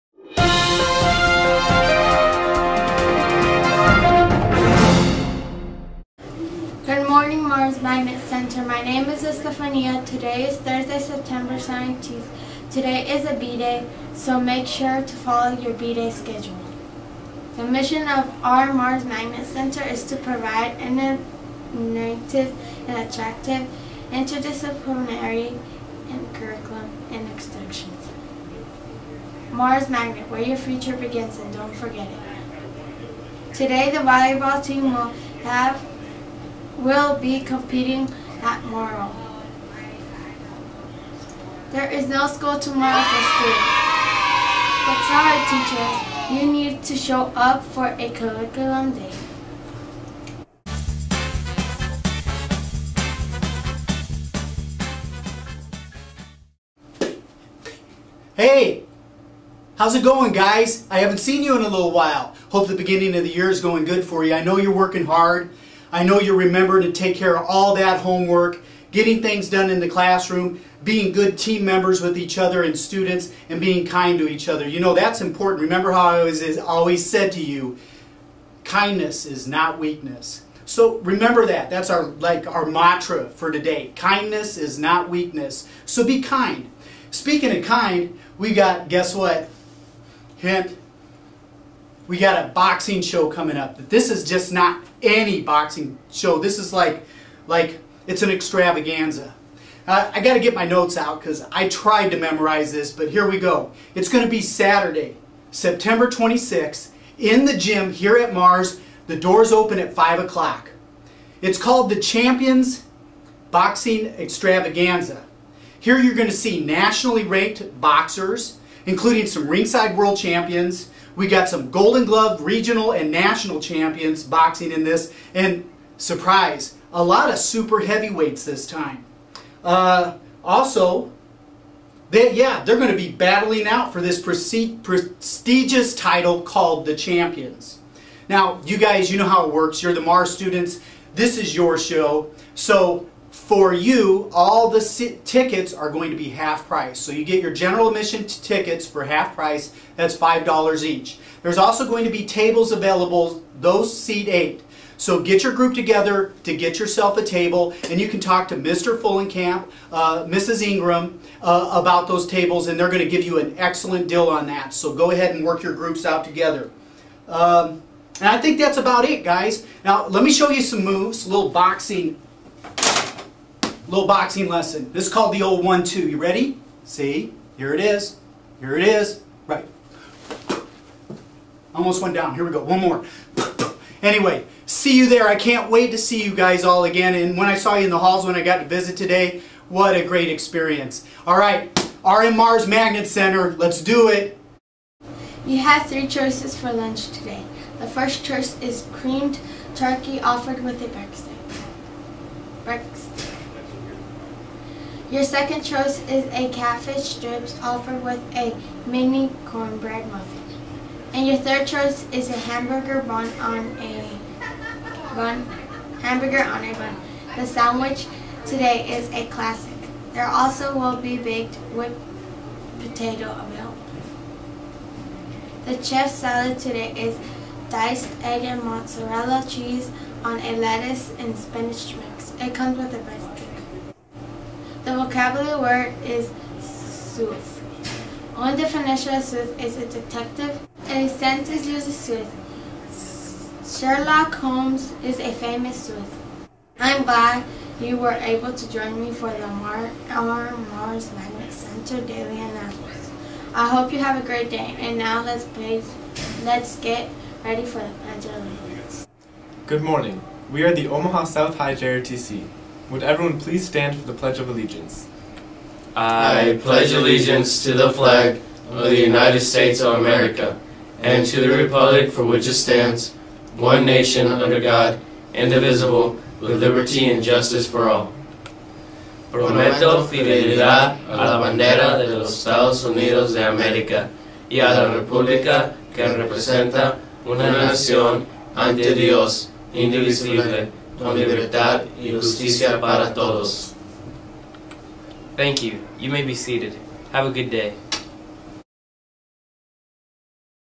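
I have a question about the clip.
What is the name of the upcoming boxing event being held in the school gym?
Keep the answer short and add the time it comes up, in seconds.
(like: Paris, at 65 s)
Champions Boxing Extravaganza, at 112 s.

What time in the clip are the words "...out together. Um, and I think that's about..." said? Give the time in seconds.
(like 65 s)
166 s.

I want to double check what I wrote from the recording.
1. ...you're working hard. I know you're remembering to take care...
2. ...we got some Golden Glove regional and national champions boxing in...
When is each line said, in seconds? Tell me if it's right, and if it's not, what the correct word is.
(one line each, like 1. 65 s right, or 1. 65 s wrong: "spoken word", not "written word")
1. 64 s right
2. 121 s right.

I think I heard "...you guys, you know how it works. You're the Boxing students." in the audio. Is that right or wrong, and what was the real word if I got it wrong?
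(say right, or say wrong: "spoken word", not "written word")
wrong: "Marrs", not "Boxing".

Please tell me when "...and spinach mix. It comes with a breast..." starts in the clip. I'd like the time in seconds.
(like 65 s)
231 s.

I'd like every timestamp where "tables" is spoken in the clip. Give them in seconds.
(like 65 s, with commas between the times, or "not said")
152 s, 157 s, 162 s.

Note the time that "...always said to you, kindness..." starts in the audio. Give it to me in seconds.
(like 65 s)
76 s.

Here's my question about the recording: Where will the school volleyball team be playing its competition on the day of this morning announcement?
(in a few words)
Morrow.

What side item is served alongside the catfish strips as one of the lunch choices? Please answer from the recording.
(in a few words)
mini cornbread muffin.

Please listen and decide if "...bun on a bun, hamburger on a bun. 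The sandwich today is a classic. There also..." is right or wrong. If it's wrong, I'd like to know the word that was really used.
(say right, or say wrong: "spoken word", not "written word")
right.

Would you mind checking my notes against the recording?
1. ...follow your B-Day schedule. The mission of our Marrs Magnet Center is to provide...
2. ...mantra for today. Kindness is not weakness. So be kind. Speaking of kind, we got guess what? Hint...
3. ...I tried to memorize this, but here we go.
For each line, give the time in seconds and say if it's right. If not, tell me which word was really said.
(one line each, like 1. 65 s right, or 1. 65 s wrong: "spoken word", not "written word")
1. 15 s right
2. 82 s right
3. 101 s right.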